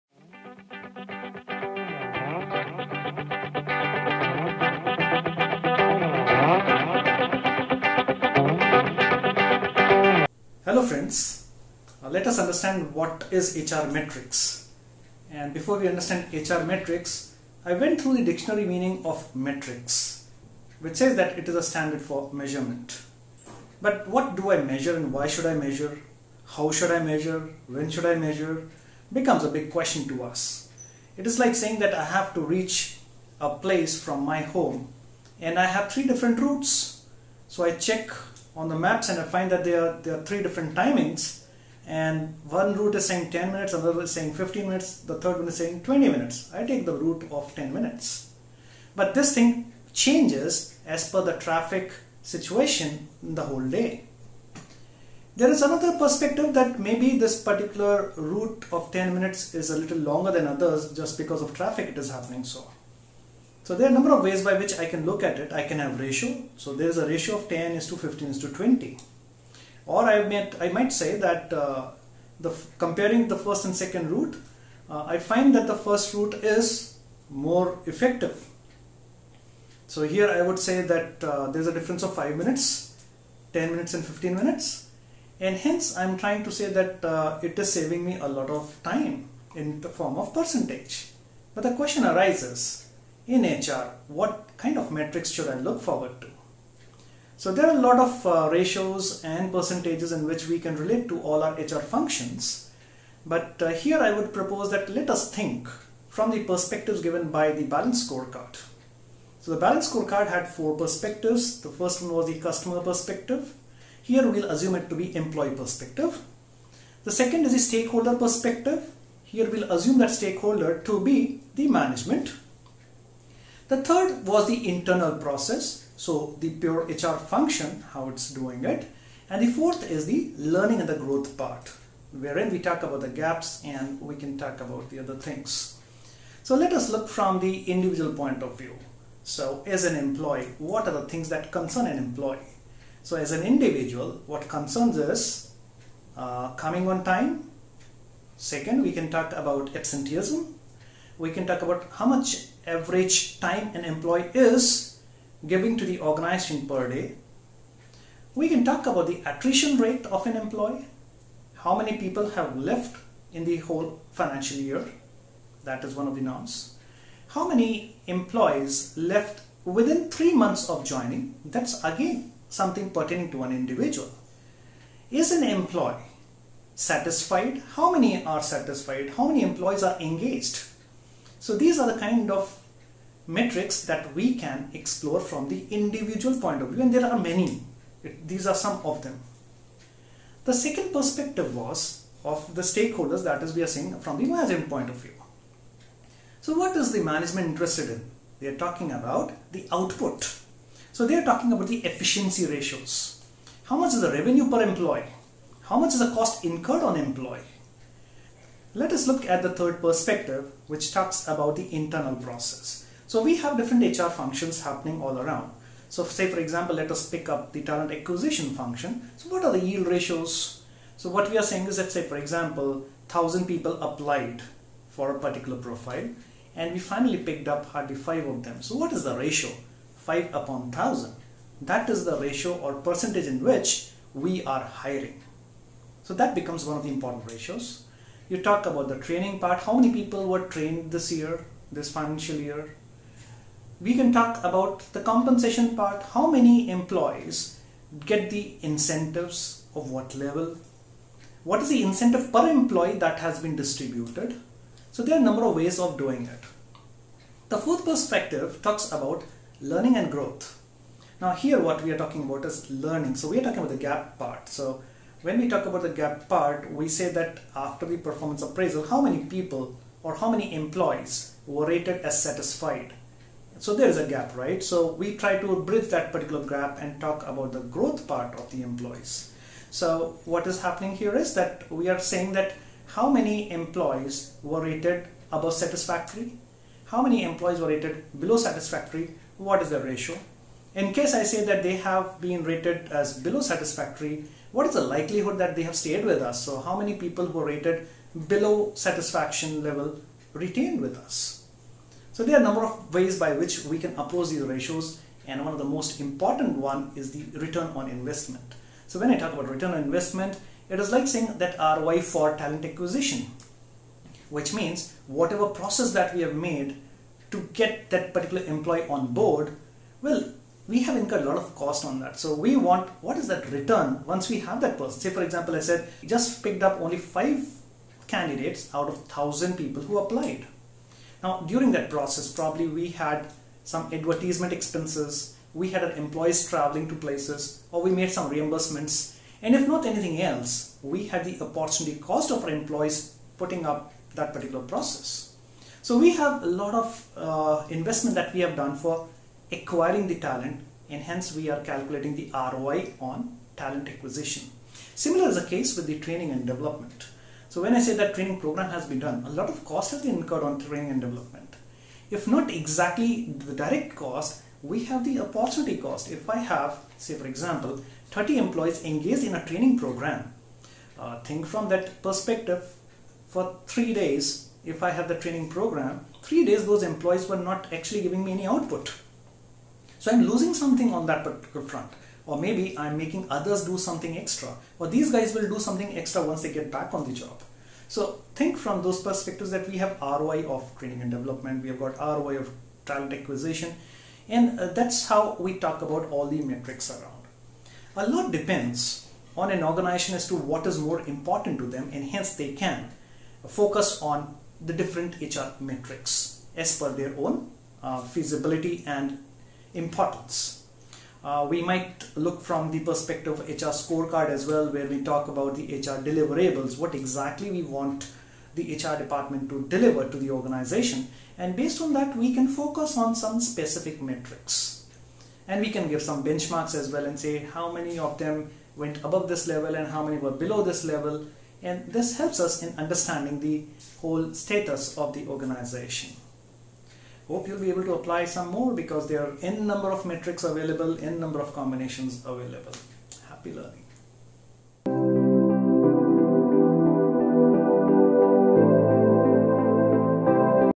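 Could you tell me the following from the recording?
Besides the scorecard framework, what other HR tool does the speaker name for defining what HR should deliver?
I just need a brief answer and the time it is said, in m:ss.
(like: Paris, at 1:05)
HR scorecard, at 6:53.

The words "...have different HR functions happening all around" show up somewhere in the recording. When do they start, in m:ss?
3:33.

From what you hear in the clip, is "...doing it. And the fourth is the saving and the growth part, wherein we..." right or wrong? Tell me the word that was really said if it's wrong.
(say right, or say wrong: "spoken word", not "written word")
wrong: "learning", not "saving".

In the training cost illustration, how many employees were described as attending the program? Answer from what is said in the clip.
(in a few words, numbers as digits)
30.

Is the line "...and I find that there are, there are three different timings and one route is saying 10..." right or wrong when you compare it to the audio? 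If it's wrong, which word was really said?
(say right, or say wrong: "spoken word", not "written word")
right.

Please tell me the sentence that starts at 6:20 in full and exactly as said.
So I'm losing something on that particular front.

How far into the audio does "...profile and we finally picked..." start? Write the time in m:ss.
3:45.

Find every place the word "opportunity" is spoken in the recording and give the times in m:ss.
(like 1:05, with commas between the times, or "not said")
5:41, 6:05.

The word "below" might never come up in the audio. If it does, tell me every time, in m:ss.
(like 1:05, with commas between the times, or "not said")
4:48, 4:53, 4:58, 7:10.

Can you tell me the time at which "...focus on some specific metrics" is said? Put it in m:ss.
7:02.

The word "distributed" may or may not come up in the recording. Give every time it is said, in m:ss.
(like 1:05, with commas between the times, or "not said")
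4:13.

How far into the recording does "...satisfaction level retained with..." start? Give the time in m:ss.
4:58.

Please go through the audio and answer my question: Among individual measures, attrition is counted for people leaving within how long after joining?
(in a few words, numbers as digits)
three months.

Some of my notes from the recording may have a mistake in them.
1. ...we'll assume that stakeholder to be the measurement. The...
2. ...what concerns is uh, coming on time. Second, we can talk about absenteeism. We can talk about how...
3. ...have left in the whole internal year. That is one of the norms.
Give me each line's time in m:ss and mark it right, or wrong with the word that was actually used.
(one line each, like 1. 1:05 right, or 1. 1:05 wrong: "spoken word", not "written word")
1. 1:59 wrong: "management", not "measurement"
2. 2:24 right
3. 2:42 wrong: "financial", not "internal".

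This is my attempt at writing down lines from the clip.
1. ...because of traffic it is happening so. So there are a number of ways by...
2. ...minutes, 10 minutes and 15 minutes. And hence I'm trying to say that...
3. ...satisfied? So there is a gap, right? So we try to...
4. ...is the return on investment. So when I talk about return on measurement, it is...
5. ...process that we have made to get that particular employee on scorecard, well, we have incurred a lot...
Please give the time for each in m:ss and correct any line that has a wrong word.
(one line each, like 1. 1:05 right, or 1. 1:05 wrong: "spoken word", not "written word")
1. 1:01 right
2. 1:22 right
3. 4:32 right
4. 5:06 wrong: "investment", not "measurement"
5. 5:15 wrong: "board", not "scorecard".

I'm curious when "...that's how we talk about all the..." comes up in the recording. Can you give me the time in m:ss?
6:34.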